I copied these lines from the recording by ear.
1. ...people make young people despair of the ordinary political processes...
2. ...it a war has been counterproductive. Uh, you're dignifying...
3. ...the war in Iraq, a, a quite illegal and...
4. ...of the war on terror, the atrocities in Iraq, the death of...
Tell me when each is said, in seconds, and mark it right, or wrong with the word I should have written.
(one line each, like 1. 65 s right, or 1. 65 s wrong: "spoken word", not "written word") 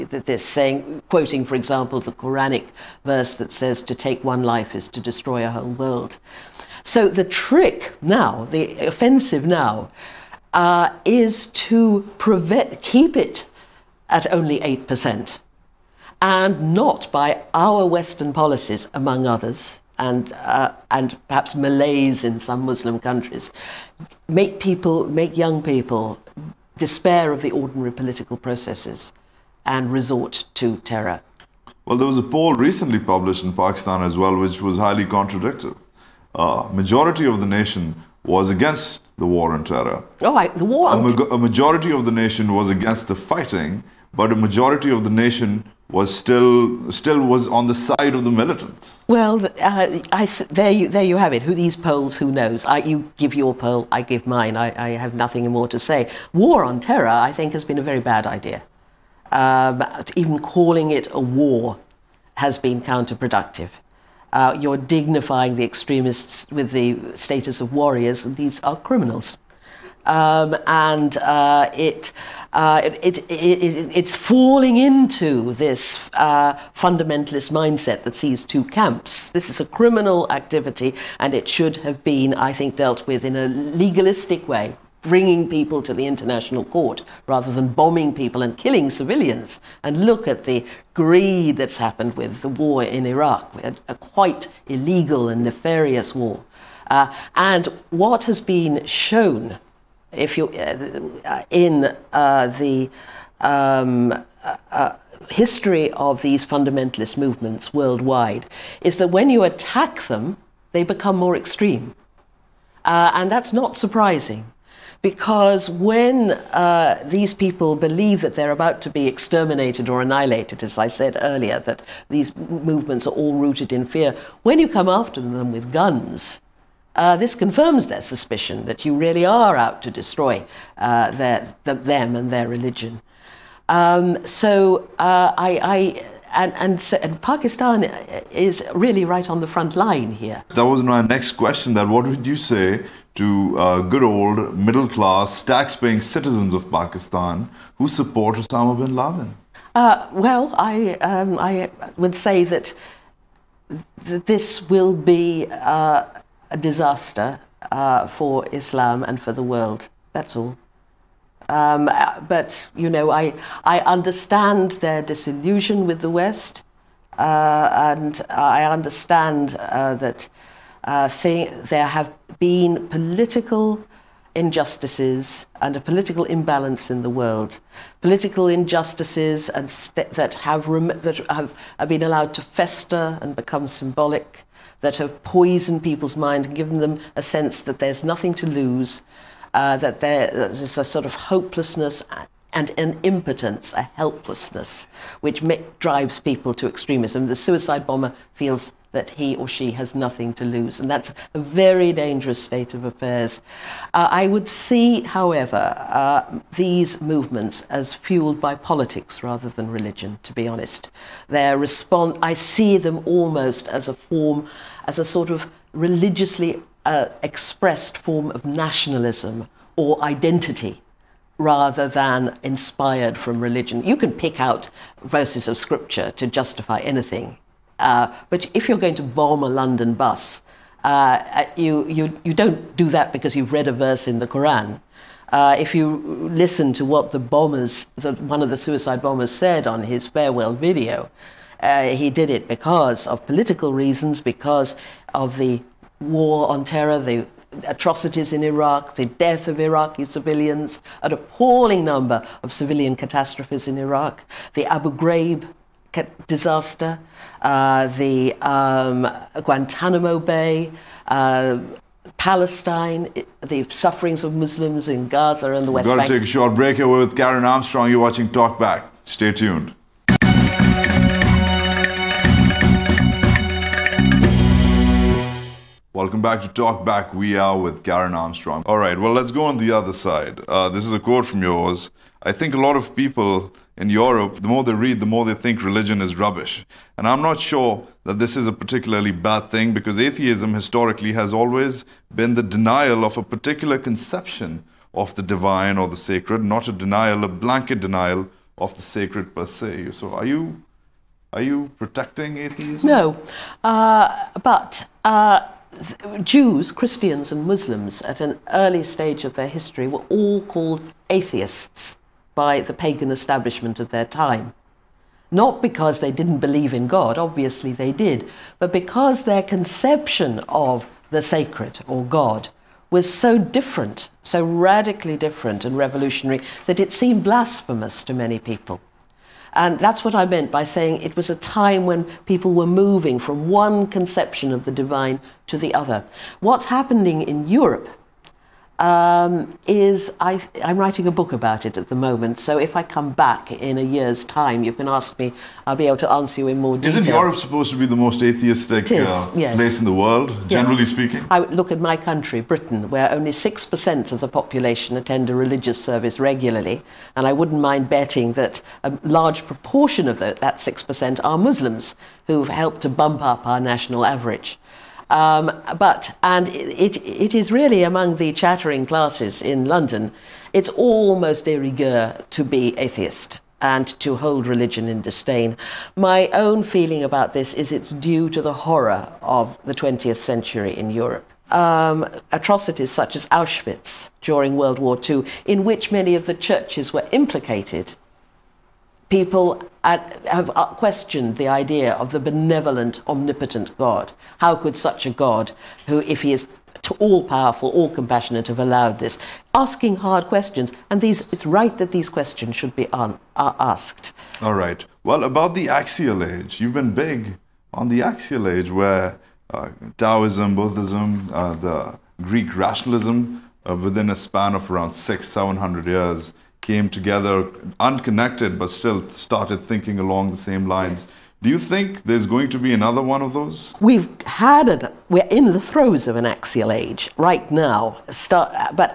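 1. 24 s right
2. 60 s right
3. 92 s right
4. 245 s right.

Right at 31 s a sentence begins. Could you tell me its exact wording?
Well, there was a poll recently published in Pakistan as well, which was highly contradictory.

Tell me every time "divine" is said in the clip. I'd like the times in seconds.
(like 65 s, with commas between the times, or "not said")
295 s, 334 s.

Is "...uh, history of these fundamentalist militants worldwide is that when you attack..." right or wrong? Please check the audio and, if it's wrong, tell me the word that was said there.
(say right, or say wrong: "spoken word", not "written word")
wrong: "movements", not "militants".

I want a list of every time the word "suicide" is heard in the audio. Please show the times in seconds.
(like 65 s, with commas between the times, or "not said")
197 s, 238 s.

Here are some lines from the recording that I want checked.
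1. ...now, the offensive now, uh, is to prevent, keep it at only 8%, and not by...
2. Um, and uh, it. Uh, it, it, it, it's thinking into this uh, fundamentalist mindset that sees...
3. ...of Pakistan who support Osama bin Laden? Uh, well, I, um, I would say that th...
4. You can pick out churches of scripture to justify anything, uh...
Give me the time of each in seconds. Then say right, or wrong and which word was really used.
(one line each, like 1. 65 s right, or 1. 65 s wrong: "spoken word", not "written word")
1. 8 s right
2. 70 s wrong: "falling", not "thinking"
3. 146 s right
4. 223 s wrong: "verses", not "churches".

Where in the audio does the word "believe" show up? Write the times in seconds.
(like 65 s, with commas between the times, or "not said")
117 s, 316 s.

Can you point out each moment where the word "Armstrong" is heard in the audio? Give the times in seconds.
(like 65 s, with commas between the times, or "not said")
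267 s, 278 s.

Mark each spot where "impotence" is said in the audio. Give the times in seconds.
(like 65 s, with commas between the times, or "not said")
193 s.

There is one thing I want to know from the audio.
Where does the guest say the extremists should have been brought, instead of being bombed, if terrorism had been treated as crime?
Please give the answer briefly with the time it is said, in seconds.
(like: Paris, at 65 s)
The international court, at 85 s.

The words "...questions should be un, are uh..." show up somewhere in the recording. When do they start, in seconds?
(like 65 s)
402 s.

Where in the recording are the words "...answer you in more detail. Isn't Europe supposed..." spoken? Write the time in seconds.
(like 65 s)
346 s.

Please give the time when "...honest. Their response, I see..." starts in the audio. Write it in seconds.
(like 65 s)
210 s.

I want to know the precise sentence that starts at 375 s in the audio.
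My own feeling about this is it's due to the horror of the 20th century in Europe.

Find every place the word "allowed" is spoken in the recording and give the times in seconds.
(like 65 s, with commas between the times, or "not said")
182 s, 398 s.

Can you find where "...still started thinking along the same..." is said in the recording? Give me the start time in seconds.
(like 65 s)
418 s.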